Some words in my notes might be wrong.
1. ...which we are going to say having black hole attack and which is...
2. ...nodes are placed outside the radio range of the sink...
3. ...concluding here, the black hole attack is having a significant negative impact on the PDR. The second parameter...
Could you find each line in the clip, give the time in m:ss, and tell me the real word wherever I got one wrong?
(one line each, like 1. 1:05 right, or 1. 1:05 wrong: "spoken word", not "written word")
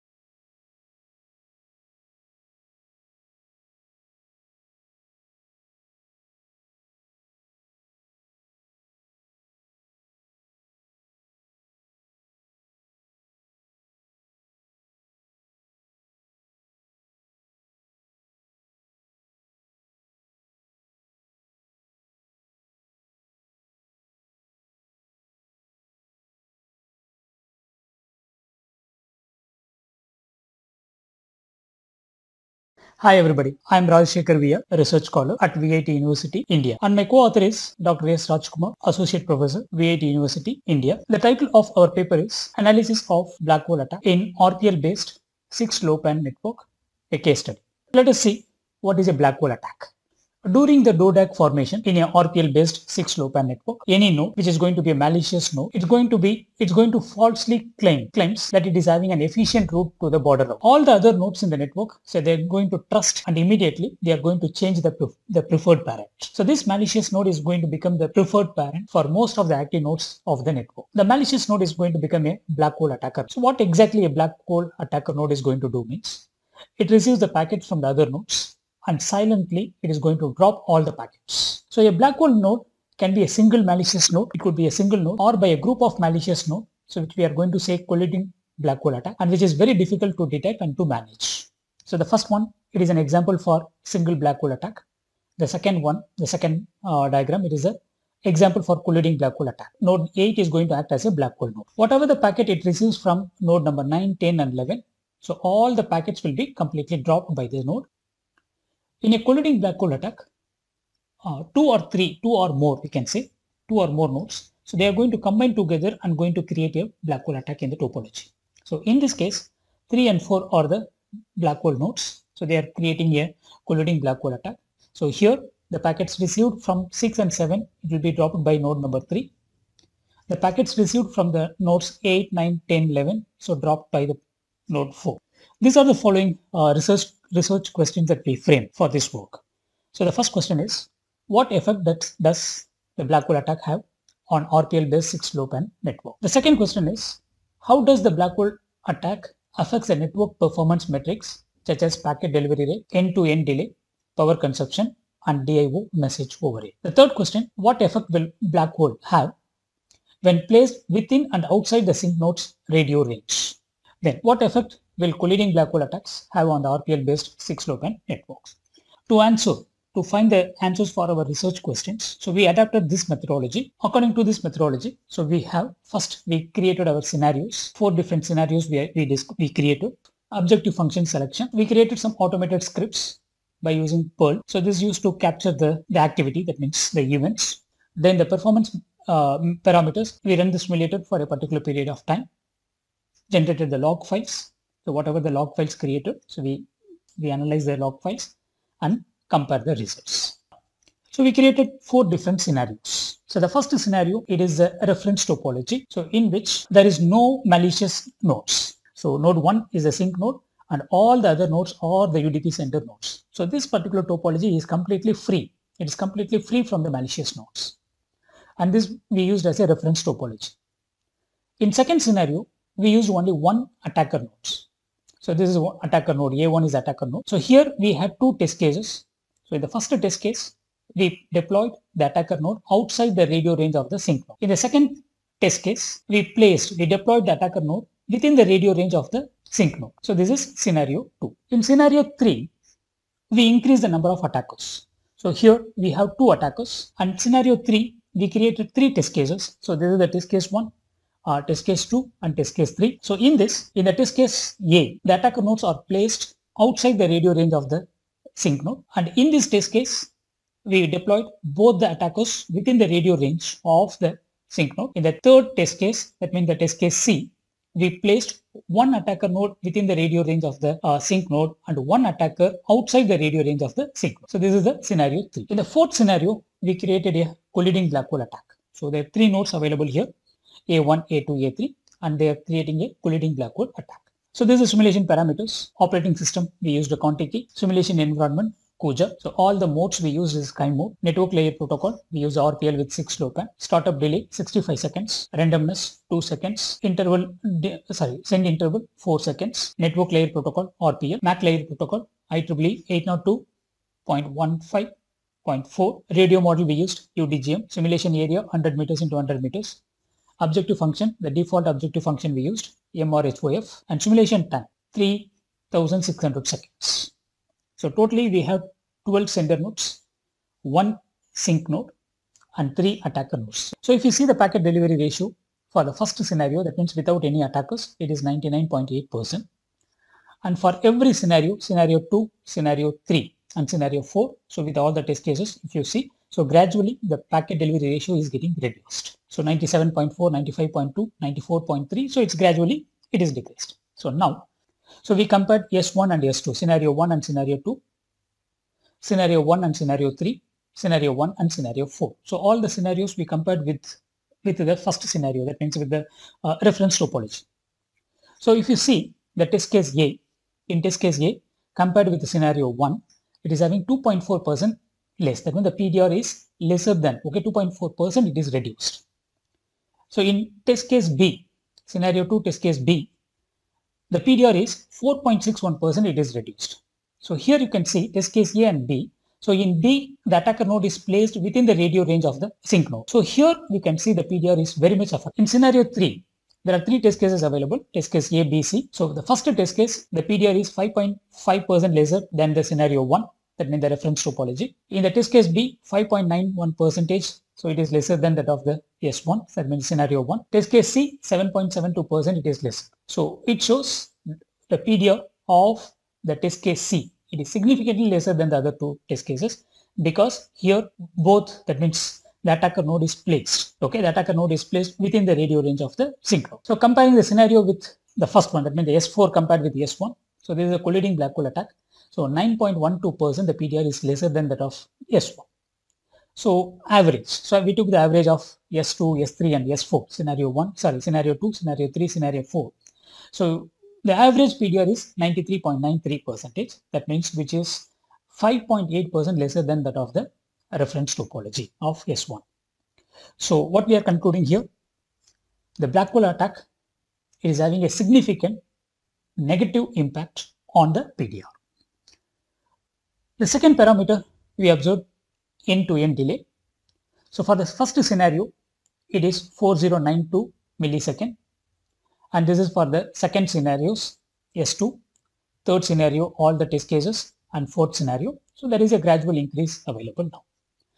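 1. 1:27 wrong: "colliding", not "having"
2. 4:15 right
3. 7:24 right.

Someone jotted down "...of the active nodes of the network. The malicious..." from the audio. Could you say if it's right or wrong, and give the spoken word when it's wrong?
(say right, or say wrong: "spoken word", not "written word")
right.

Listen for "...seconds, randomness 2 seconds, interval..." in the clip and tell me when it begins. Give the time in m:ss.
4:54.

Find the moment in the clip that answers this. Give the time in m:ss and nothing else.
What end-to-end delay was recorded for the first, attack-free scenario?
7:39.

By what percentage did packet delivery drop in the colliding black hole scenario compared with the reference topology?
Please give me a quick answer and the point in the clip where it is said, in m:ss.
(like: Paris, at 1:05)
9.12%, at 7:02.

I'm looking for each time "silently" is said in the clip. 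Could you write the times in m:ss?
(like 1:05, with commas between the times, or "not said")
1:19.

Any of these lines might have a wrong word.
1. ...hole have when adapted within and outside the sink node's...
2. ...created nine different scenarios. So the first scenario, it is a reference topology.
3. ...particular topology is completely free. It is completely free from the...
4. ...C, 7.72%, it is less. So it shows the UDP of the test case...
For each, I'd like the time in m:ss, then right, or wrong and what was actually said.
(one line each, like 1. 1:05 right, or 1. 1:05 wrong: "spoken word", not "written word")
1. 2:38 wrong: "placed", not "adapted"
2. 3:21 wrong: "four", not "nine"
3. 3:33 right
4. 6:40 wrong: "PDR", not "UDP".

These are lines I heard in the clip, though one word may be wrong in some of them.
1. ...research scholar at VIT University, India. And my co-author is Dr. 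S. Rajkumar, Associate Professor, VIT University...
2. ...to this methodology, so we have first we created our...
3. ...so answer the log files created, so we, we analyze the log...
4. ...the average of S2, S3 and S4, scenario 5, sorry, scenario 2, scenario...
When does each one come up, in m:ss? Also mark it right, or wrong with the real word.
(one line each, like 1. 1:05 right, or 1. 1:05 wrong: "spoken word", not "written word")
1. 0:34 right
2. 2:54 right
3. 3:14 wrong: "whatever", not "answer"
4. 7:07 wrong: "1", not "5".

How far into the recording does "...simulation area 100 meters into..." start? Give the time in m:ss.
5:07.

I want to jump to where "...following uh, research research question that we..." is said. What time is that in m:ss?
2:15.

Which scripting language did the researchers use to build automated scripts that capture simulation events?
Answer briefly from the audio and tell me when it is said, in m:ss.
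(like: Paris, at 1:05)
Perl, at 3:04.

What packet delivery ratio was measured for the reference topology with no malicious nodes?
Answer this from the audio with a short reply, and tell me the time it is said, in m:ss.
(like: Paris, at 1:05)
99.8%, at 5:28.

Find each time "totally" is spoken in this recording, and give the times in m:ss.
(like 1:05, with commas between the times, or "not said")
5:17.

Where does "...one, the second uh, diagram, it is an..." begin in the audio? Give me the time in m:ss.
1:35.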